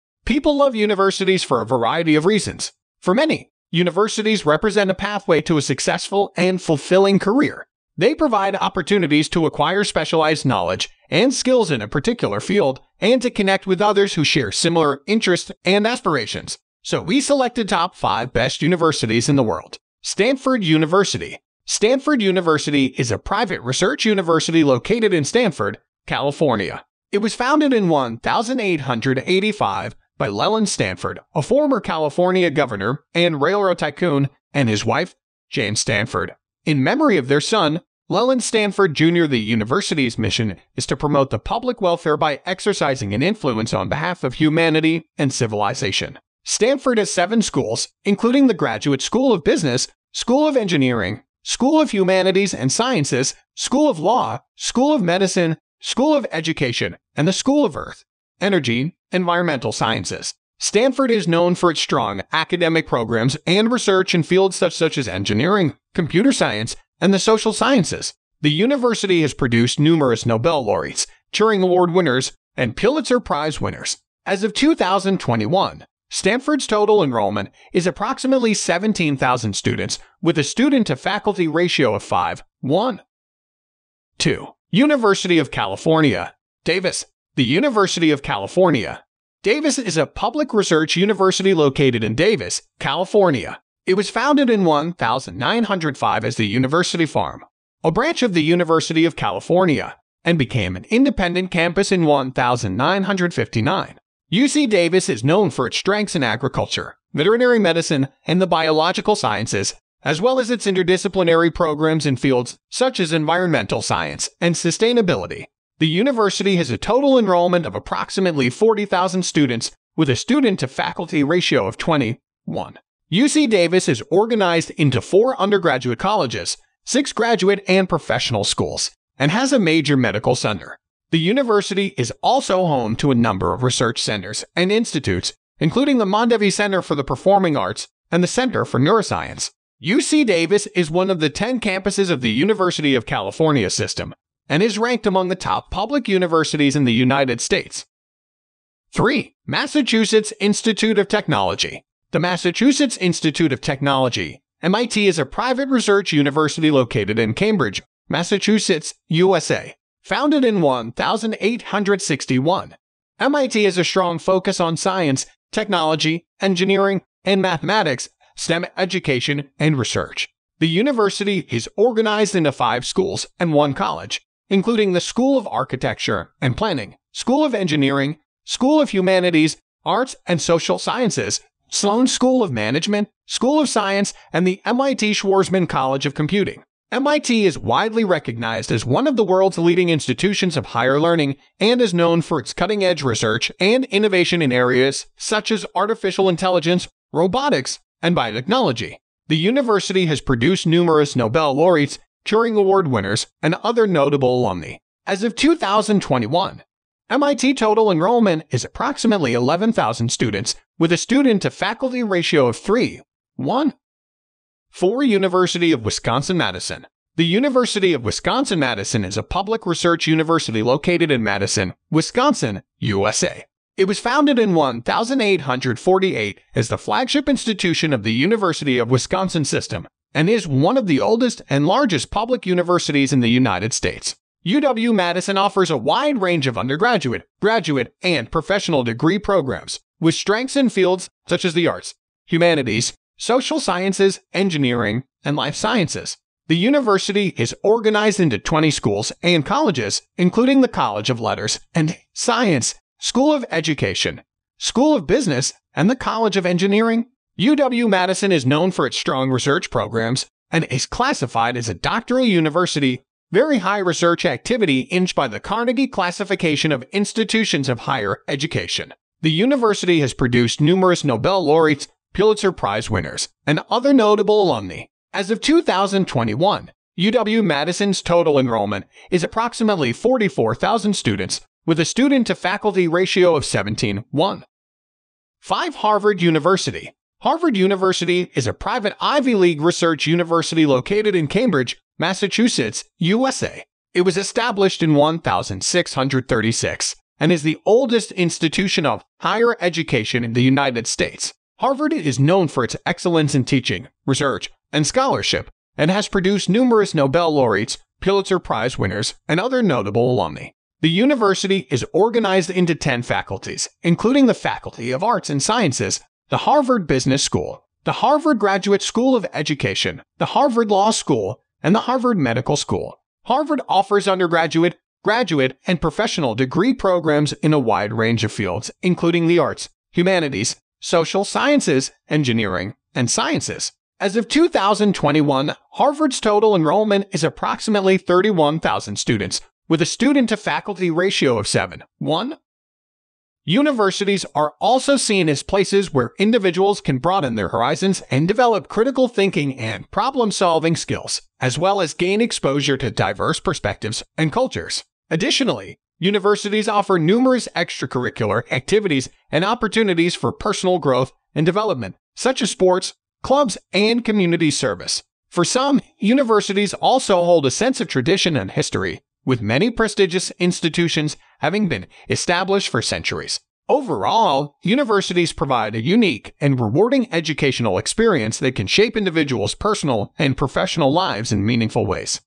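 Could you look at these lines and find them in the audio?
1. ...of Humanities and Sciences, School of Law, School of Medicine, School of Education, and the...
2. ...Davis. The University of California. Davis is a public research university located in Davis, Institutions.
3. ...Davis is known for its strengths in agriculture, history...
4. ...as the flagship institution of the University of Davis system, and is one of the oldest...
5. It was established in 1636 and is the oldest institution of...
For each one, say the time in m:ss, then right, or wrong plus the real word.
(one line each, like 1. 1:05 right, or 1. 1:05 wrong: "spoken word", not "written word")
1. 0:51 right
2. 1:26 wrong: "California", not "Institutions"
3. 1:44 wrong: "veterinary", not "history"
4. 3:46 wrong: "Wisconsin", not "Davis"
5. 4:53 right.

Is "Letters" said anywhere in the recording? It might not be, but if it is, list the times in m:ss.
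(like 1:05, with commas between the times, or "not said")
4:11.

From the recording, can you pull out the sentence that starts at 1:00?
Stanford is known for its strong academic programs and research in fields such, such as engineering, computer science, and the social sciences.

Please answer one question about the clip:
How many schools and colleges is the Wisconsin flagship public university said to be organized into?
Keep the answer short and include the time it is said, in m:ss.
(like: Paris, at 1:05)
20, at 4:08.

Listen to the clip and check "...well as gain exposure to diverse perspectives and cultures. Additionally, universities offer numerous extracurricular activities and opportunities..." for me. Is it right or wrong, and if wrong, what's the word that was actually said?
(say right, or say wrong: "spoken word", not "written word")
right.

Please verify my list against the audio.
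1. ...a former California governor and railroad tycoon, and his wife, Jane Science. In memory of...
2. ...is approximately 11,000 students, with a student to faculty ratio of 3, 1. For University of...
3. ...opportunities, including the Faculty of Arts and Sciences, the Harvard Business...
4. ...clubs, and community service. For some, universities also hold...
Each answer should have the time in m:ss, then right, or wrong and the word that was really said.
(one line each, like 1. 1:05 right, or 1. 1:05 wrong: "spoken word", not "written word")
1. 0:31 wrong: "Stanford", not "Science"
2. 3:28 right
3. 5:13 wrong: "faculties", not "opportunities"
4. 6:03 right.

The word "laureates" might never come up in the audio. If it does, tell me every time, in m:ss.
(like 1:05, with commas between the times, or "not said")
1:10, 3:21, 4:31, 5:07.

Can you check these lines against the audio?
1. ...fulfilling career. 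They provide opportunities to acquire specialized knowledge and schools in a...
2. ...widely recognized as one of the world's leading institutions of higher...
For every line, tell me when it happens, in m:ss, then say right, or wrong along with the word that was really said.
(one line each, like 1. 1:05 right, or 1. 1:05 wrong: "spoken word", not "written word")
1. 0:06 wrong: "skills", not "schools"
2. 3:07 right.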